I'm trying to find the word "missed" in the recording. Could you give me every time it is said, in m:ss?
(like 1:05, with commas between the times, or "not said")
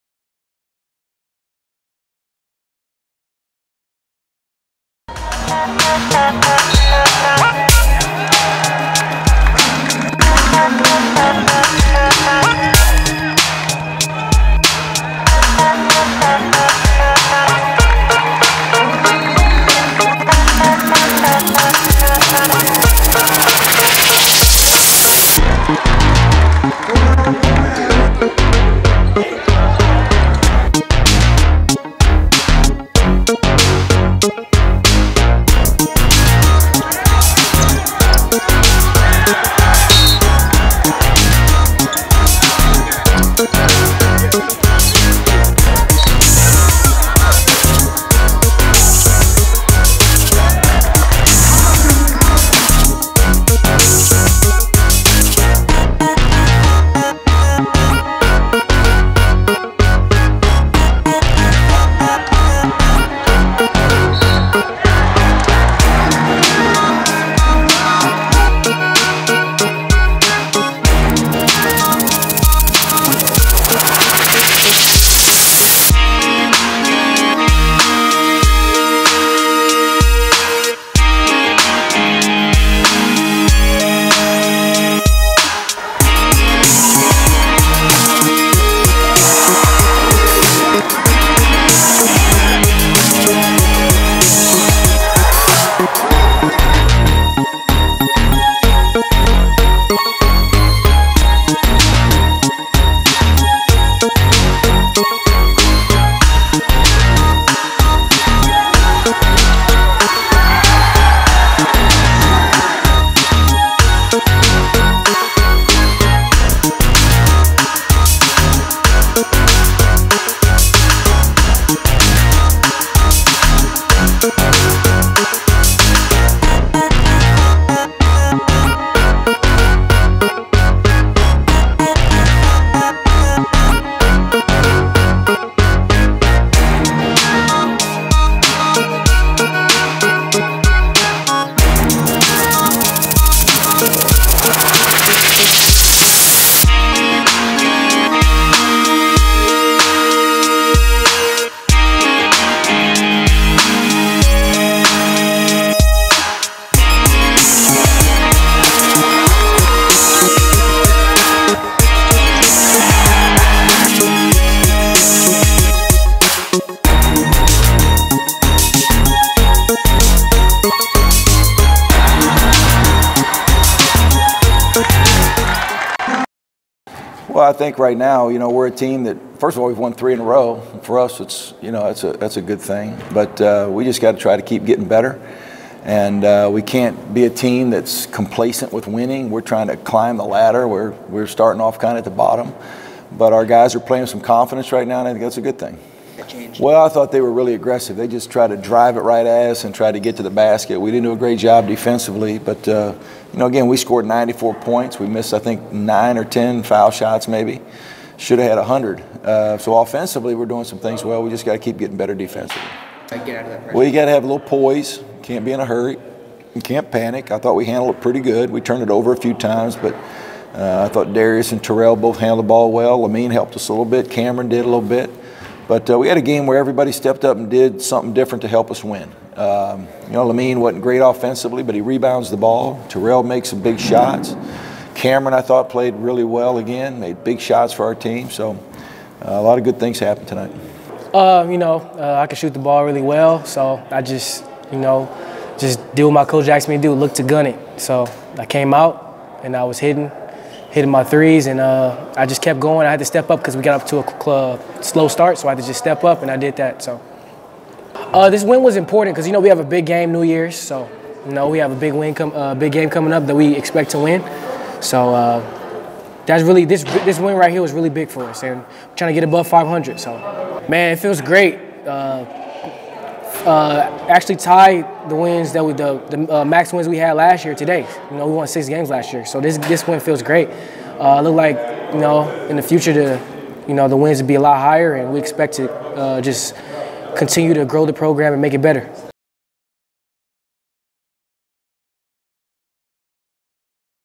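3:25.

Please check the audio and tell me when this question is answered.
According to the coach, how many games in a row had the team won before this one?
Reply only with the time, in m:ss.
2:59.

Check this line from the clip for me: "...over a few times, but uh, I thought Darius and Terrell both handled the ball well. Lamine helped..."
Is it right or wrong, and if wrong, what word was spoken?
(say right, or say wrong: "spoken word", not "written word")
right.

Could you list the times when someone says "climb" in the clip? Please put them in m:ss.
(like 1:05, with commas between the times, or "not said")
3:09.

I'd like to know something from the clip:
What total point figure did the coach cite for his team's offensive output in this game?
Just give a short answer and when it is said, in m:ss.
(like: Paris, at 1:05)
94, at 3:24.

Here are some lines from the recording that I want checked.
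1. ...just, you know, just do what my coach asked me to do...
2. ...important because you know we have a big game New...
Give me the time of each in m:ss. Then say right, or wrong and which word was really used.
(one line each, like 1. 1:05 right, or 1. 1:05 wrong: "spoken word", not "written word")
1. 4:04 right
2. 4:18 right.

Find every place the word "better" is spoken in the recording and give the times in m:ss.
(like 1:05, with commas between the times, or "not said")
3:04, 3:31, 4:48.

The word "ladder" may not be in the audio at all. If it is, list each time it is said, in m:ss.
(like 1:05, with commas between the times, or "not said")
3:10.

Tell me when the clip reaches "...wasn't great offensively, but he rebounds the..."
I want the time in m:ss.
3:50.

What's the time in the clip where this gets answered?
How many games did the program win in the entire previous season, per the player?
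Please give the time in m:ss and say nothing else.
4:38.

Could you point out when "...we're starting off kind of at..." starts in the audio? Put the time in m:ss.
3:10.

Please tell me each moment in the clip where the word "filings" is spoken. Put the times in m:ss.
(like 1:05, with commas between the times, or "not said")
not said.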